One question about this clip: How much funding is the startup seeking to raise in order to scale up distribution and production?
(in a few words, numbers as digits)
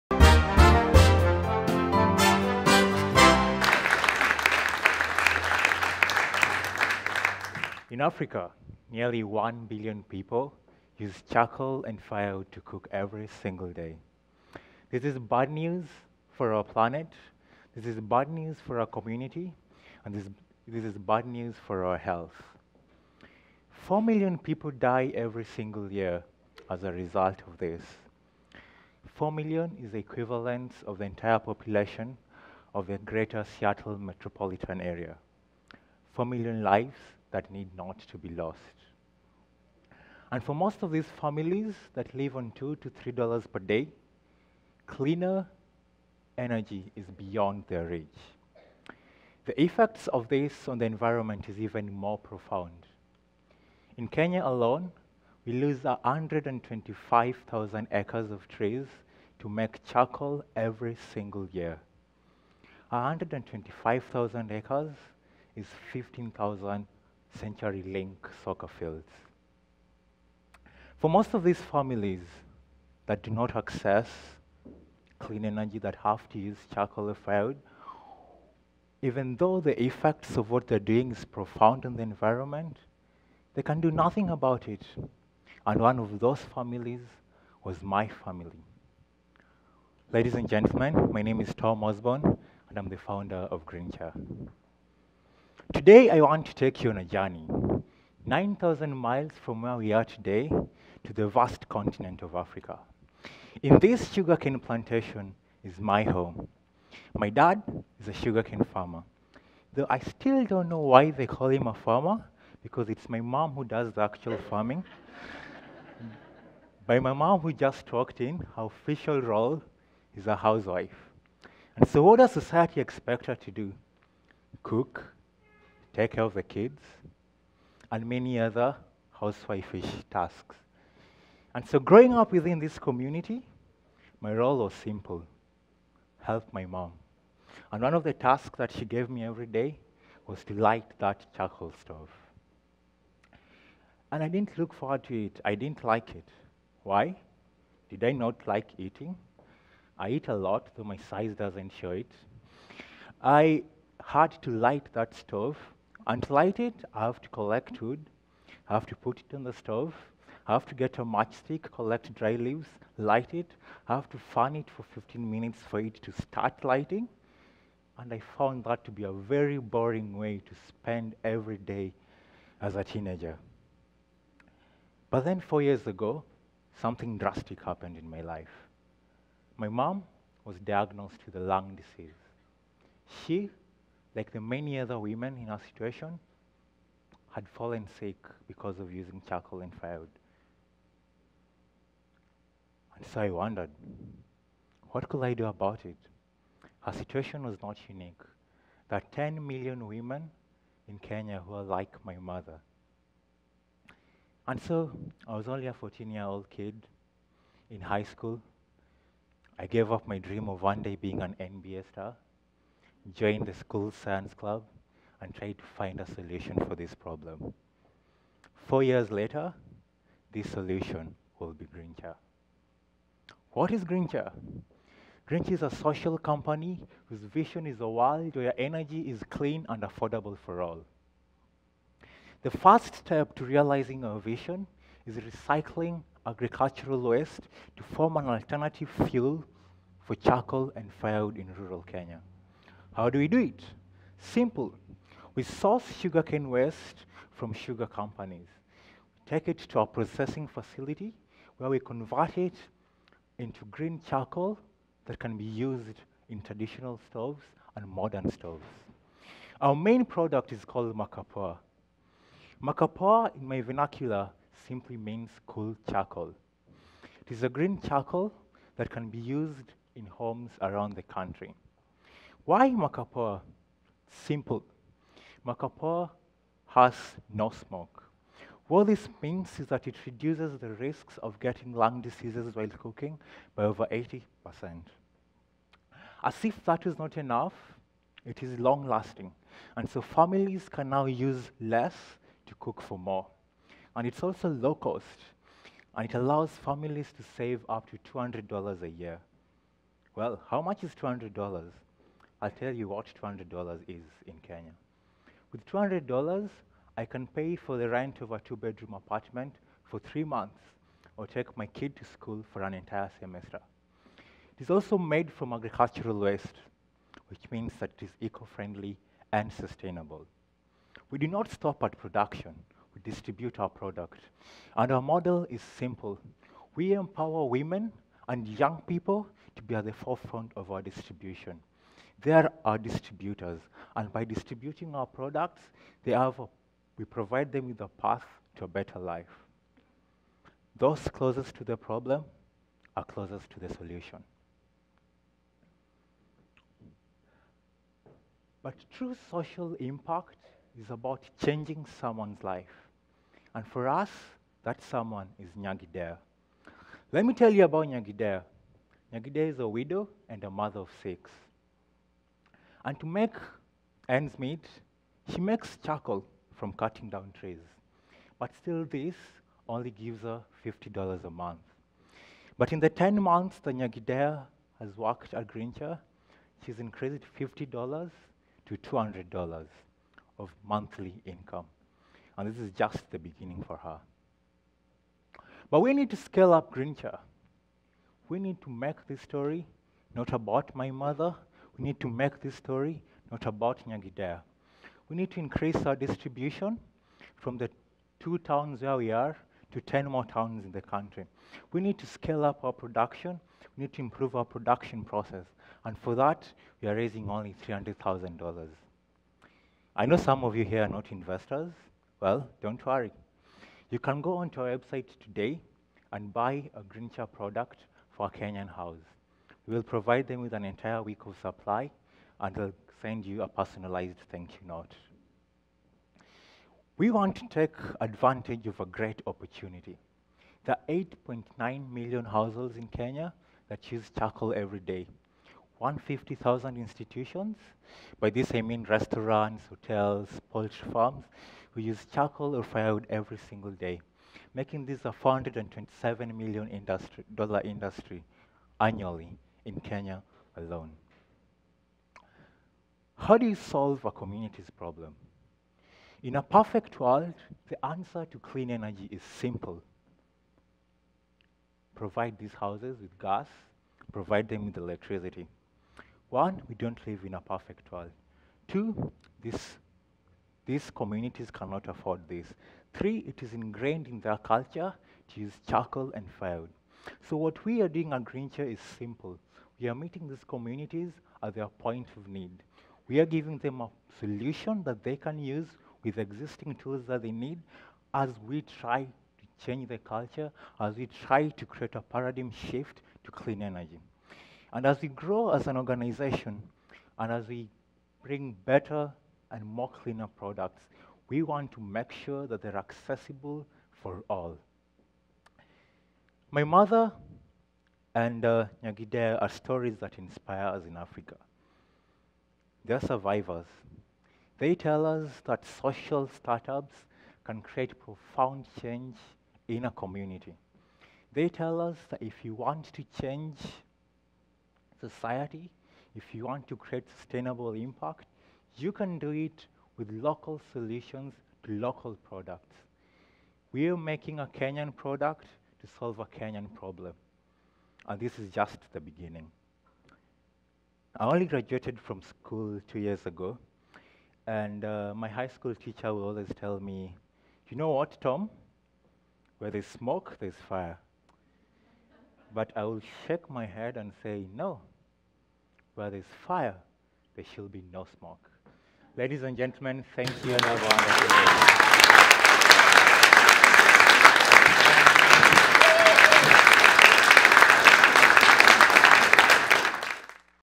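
$300,000.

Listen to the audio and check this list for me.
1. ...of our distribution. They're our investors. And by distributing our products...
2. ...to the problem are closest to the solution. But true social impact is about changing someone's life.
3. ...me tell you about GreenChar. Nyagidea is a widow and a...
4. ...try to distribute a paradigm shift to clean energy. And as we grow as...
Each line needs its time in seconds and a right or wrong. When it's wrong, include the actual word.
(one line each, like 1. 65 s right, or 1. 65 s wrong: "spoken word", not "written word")
1. 330 s wrong: "distributors", not "investors"
2. 341 s right
3. 357 s wrong: "Nyagidea", not "GreenChar"
4. 491 s wrong: "create", not "distribute".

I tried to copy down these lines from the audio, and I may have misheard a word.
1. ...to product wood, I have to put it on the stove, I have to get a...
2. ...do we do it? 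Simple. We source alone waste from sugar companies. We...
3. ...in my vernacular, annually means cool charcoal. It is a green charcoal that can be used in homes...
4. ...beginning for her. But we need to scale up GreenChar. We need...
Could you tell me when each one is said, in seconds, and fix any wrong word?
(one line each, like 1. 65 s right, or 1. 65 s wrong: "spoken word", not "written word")
1. 157 s wrong: "collect", not "product"
2. 243 s wrong: "sugarcane", not "alone"
3. 263 s wrong: "simply", not "annually"
4. 383 s right.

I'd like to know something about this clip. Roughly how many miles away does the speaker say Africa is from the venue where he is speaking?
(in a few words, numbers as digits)
9,000.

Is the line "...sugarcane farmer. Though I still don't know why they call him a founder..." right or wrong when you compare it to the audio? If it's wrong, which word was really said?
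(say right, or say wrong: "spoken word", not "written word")
wrong: "farmer", not "founder".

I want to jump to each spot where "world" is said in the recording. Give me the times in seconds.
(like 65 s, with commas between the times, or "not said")
227 s, 456 s, 467 s.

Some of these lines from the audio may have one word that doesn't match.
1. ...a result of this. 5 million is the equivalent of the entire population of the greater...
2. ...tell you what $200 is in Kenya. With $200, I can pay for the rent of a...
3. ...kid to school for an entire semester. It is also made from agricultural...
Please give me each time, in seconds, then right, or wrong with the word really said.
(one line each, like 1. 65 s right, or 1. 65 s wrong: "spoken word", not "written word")
1. 26 s wrong: "4", not "5"
2. 302 s right
3. 311 s right.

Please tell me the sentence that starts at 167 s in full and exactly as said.
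And I found that to be a very boring way to spend every day as a teenager.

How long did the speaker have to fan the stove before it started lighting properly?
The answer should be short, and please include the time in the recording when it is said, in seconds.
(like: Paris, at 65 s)
15 minutes, at 164 s.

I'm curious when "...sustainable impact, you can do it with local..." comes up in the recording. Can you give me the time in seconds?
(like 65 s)
527 s.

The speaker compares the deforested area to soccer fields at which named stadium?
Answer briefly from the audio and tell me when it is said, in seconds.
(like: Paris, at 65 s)
CenturyLink, at 67 s.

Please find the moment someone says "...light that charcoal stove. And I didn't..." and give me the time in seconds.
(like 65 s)
140 s.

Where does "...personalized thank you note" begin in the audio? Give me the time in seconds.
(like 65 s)
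423 s.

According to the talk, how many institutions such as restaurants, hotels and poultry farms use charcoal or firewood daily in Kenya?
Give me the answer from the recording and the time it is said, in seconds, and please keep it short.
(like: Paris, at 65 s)
150,000, at 435 s.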